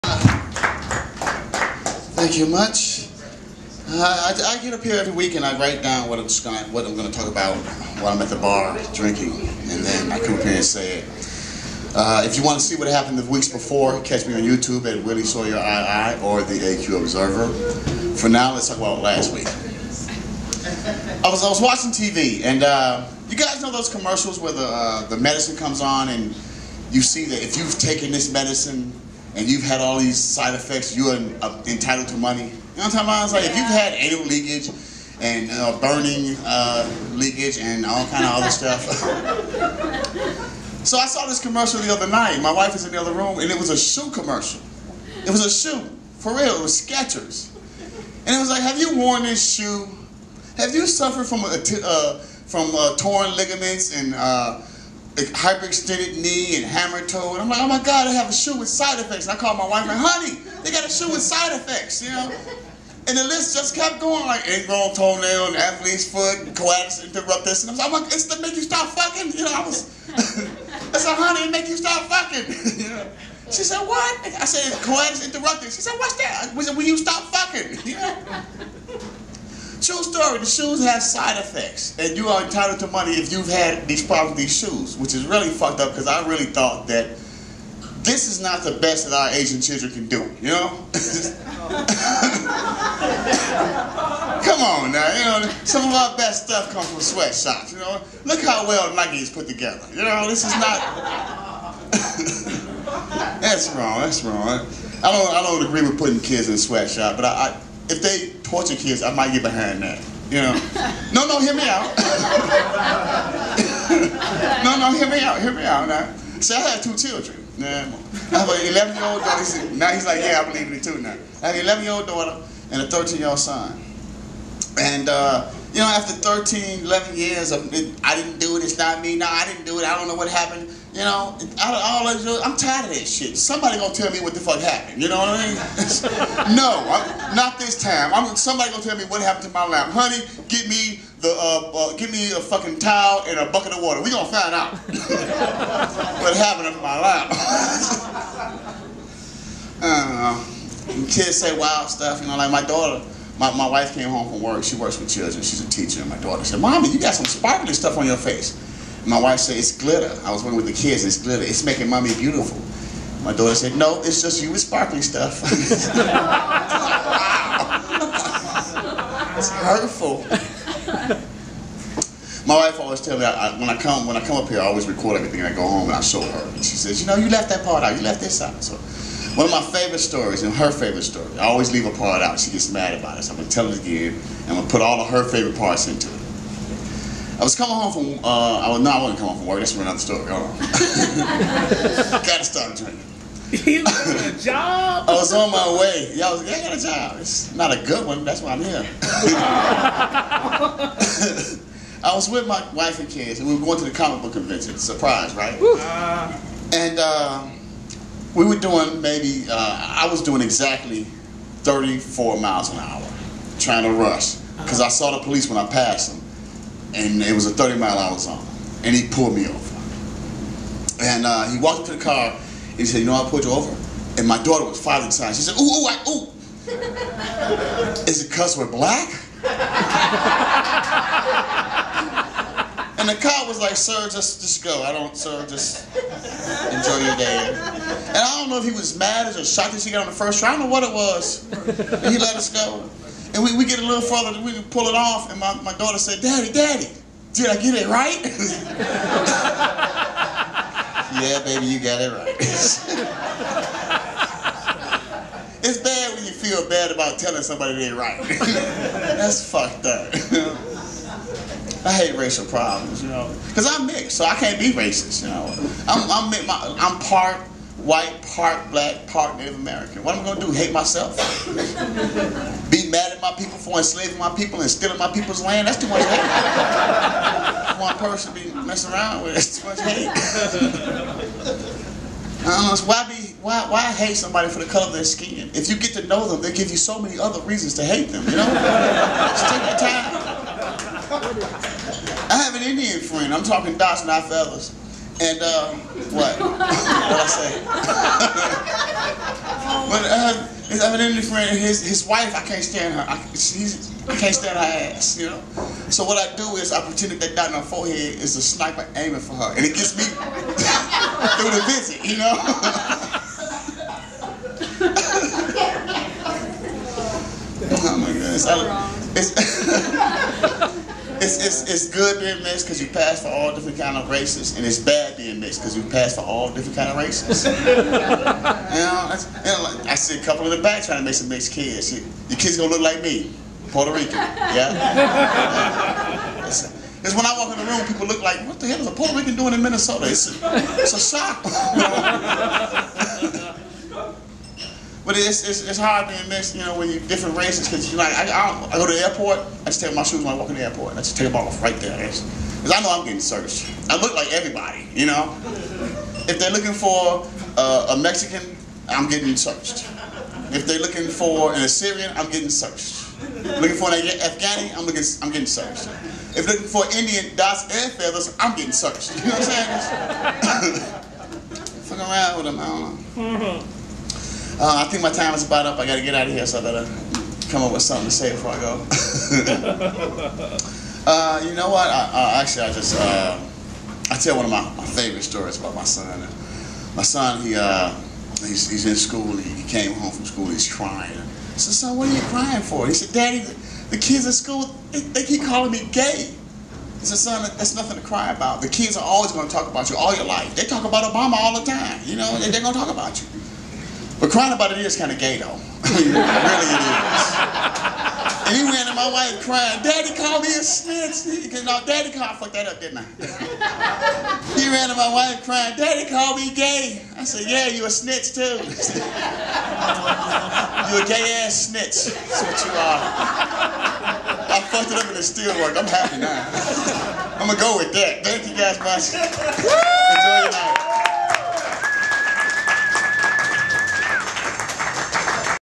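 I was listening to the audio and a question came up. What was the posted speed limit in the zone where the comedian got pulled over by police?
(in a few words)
30 mph.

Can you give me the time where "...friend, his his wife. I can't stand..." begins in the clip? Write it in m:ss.
5:01.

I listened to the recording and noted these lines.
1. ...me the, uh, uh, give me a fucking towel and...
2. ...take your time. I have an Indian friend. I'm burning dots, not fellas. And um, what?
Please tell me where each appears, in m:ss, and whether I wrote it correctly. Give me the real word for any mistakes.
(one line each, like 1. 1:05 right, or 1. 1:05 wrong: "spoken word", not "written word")
1. 2:20 right
2. 4:49 wrong: "talking", not "burning".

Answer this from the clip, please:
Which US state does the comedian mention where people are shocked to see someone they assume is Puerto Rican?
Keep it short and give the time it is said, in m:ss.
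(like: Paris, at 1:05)
Minnesota, at 5:39.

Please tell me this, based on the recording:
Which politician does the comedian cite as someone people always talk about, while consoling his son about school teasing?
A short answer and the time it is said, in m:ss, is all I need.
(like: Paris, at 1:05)
Obama, at 6:41.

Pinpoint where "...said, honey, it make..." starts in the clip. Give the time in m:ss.
1:11.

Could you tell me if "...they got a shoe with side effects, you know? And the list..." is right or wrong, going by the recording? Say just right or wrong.
right.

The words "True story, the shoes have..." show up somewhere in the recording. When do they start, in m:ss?
1:19.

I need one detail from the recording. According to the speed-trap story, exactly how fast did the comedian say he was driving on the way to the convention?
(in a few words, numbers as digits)
34 miles an hour.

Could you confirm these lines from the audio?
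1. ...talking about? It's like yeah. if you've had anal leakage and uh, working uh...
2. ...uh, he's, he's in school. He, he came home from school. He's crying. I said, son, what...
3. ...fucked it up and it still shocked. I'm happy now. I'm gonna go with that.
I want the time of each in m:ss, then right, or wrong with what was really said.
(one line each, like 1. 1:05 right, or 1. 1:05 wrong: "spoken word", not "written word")
1. 0:32 wrong: "burning", not "working"
2. 6:27 right
3. 7:04 wrong: "worked", not "shocked".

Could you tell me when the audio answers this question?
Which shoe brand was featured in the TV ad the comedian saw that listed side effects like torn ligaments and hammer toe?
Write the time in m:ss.
0:46.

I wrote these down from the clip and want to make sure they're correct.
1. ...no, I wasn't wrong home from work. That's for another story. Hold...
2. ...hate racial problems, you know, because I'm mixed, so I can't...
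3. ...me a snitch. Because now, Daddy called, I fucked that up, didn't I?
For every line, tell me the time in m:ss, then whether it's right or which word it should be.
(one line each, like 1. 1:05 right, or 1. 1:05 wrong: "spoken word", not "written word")
1. 3:08 wrong: "coming", not "wrong"
2. 4:21 right
3. 6:50 right.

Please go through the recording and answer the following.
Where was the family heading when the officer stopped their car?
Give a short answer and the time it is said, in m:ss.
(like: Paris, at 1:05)
the comic book convention, at 3:23.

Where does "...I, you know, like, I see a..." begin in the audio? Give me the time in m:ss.
5:28.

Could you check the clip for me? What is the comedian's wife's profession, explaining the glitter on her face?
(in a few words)
teacher.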